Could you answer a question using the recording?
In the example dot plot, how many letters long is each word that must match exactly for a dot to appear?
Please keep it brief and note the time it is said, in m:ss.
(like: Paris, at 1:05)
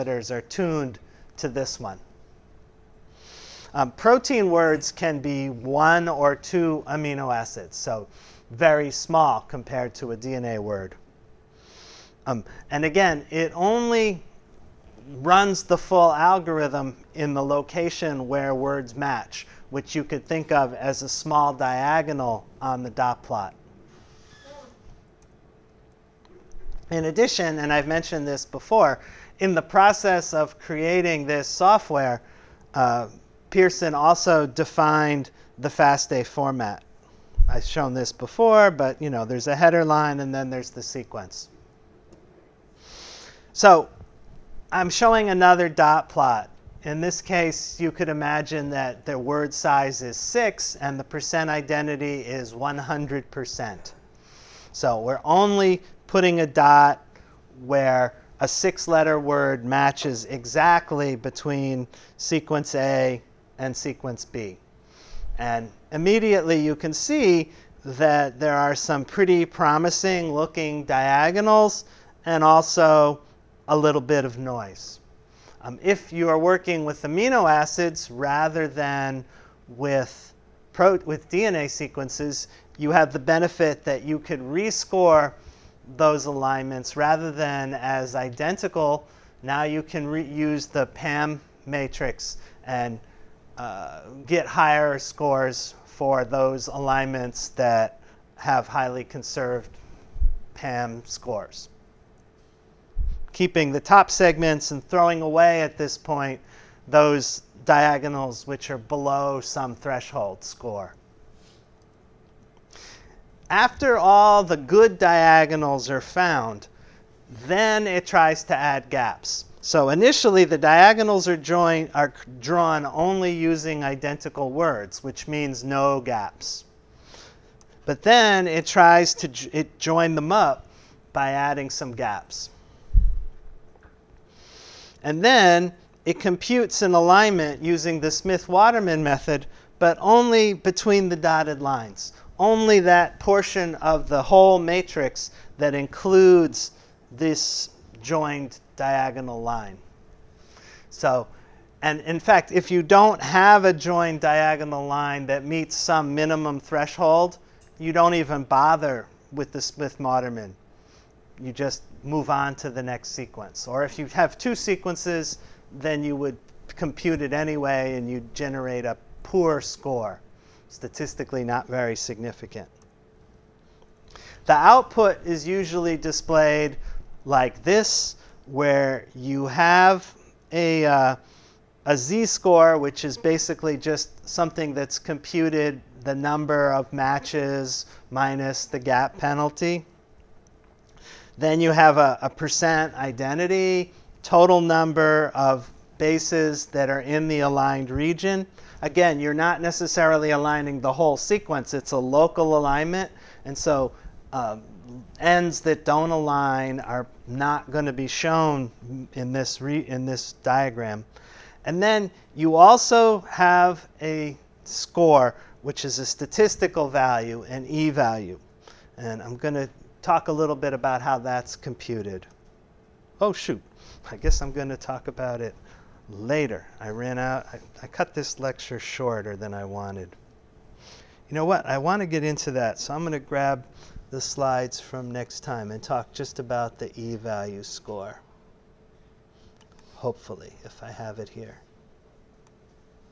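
6, at 0:50.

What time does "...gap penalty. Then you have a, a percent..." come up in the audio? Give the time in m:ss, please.
3:08.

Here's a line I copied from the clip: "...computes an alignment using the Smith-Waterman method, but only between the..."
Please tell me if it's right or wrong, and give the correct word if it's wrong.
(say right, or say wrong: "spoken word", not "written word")
right.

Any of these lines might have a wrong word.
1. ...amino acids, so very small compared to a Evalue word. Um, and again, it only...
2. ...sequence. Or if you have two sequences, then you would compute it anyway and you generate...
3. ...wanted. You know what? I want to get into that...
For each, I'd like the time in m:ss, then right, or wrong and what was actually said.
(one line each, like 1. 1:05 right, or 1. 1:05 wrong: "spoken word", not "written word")
1. 0:06 wrong: "DNA", not "Evalue"
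2. 2:43 right
3. 3:49 right.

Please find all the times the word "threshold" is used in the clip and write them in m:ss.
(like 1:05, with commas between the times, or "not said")
1:49, 2:36.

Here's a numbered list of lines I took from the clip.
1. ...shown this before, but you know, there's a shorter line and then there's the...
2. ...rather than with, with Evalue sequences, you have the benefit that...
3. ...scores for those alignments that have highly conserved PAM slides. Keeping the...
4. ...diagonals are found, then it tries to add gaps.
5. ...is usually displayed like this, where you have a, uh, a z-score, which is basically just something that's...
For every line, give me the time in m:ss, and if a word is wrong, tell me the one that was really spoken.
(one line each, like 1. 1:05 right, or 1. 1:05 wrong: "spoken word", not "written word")
1. 0:37 wrong: "header", not "shorter"
2. 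1:18 wrong: "DNA", not "Evalue"
3. 1:34 wrong: "scores", not "slides"
4. 1:54 right
5. 2:55 right.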